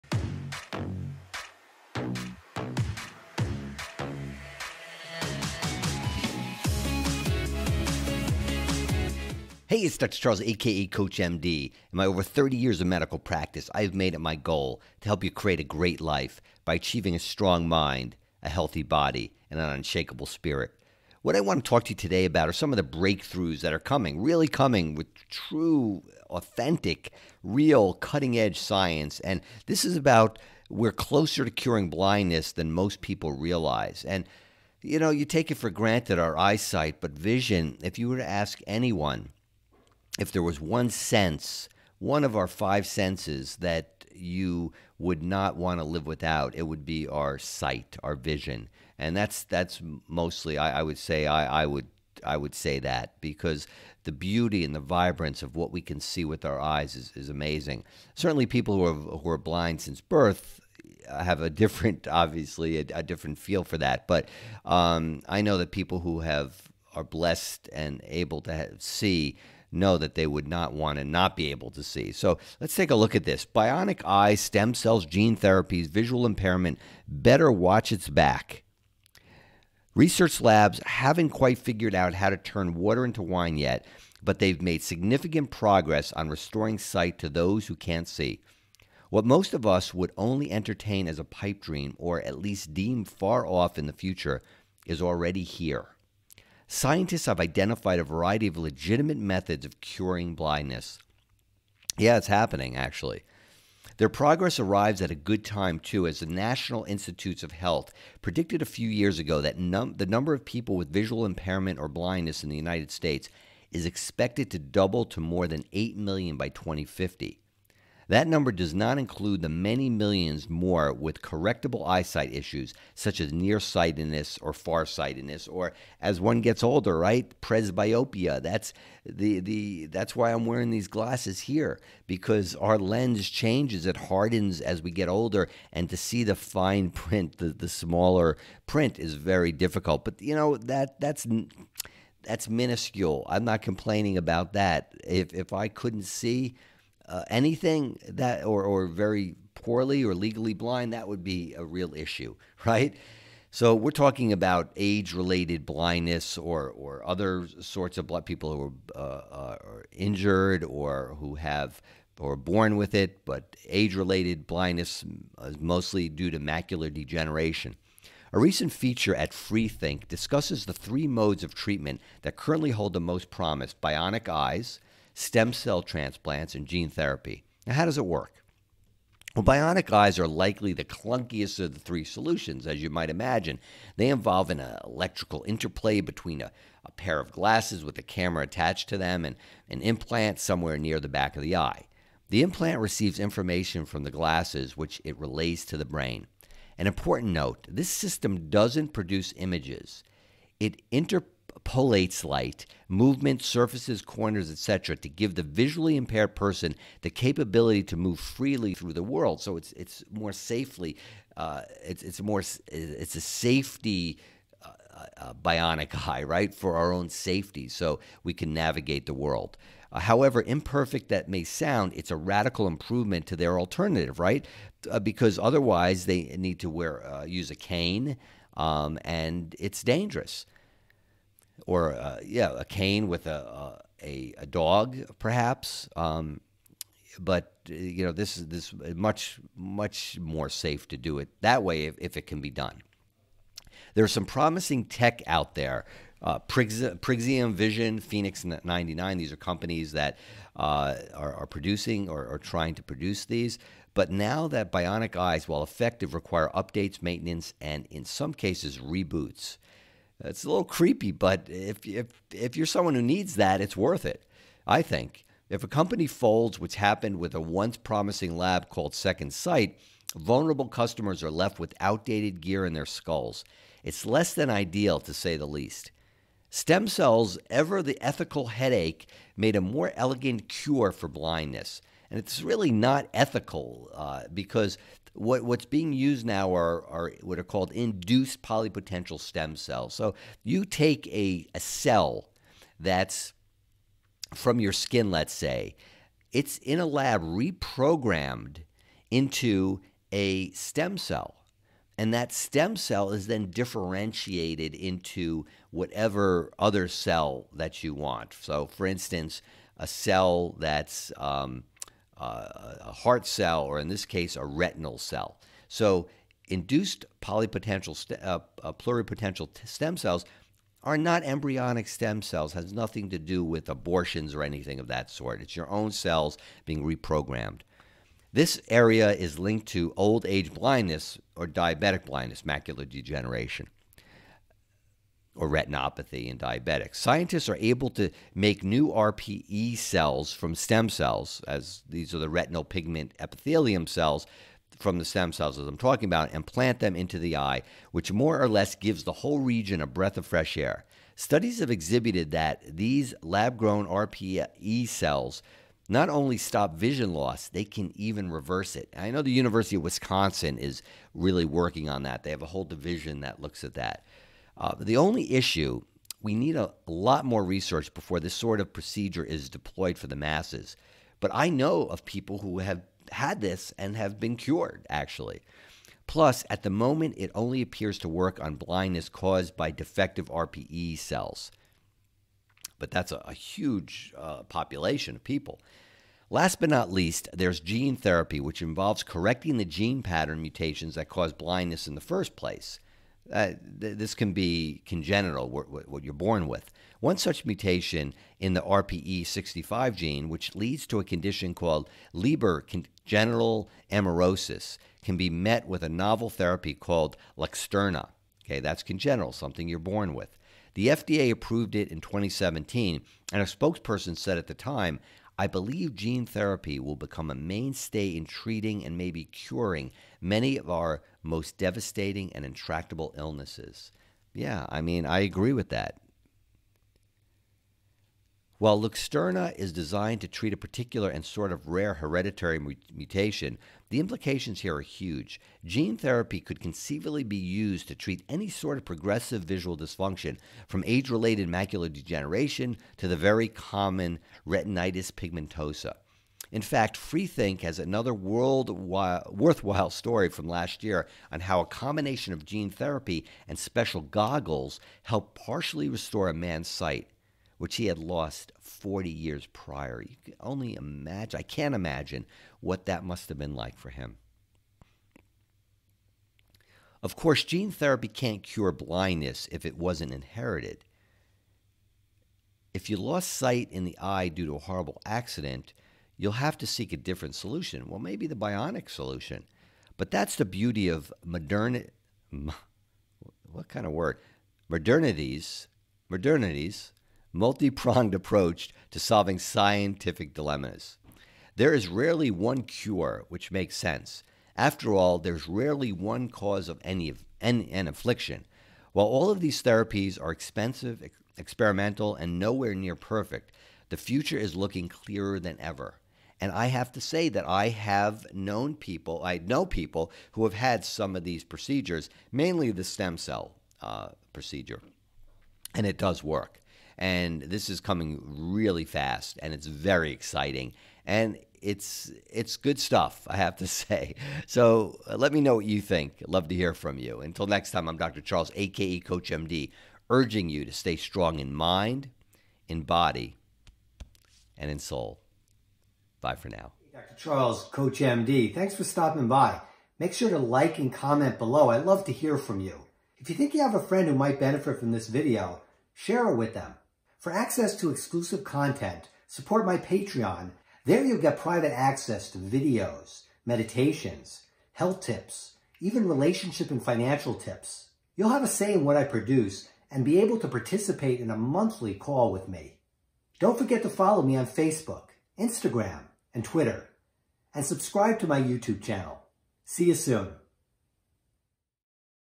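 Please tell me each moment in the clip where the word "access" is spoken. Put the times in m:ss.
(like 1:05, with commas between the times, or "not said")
9:07, 9:11.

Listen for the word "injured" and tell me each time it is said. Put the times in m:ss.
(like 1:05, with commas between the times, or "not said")
2:39.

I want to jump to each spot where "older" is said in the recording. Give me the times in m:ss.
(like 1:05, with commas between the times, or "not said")
2:06, 2:15.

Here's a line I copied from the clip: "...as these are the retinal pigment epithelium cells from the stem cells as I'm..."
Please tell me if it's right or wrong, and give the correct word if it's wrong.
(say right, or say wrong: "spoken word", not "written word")
right.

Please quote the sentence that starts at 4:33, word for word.
It's less than ideal, to say the least.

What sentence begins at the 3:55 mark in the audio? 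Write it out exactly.
Um, but you know, this is this much much more safe to do it that way if, if it can be done.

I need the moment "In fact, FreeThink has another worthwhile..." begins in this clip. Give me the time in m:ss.
7:26.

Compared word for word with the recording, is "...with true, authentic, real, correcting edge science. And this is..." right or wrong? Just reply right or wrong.
wrong.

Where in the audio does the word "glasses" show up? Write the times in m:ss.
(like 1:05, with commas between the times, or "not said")
2:10, 3:07, 3:14.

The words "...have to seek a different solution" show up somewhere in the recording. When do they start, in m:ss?
7:56.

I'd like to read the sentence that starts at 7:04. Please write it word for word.
Yeah, I mean, I agree with that.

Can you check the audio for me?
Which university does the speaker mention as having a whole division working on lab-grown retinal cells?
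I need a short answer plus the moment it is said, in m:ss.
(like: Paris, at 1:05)
University of Wisconsin, at 5:59.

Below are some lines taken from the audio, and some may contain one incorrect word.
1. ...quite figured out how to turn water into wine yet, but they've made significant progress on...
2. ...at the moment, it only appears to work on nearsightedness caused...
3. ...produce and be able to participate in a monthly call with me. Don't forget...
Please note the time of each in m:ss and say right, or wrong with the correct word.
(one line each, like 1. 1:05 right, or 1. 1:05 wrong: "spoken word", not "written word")
1. 1:21 right
2. 6:16 wrong: "blindness", not "nearsightedness"
3. 9:19 right.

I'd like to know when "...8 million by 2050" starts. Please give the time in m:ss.
1:55.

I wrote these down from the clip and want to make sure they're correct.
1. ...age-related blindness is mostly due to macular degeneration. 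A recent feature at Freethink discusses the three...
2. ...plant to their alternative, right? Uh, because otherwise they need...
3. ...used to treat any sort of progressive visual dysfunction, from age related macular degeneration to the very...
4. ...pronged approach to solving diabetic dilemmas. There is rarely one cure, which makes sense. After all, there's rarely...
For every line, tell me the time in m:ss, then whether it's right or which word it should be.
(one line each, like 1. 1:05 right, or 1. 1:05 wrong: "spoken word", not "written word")
1. 2:43 right
2. 3:42 wrong: "improvement", not "plant"
3. 7:17 right
4. 8:07 wrong: "scientific", not "diabetic".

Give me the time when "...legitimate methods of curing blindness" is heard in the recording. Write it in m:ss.
1:38.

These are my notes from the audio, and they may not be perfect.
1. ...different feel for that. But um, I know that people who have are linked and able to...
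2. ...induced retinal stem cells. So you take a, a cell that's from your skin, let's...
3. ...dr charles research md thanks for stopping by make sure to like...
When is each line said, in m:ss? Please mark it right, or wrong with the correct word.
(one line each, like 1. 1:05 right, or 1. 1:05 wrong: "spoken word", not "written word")
1. 1:03 wrong: "blessed", not "linked"
2. 4:47 wrong: "polypotential", not "retinal"
3. 8:56 wrong: "coach", not "research".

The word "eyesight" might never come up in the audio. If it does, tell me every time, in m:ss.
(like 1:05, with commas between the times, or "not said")
0:36, 2:01.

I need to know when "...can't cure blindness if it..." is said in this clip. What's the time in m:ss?
7:48.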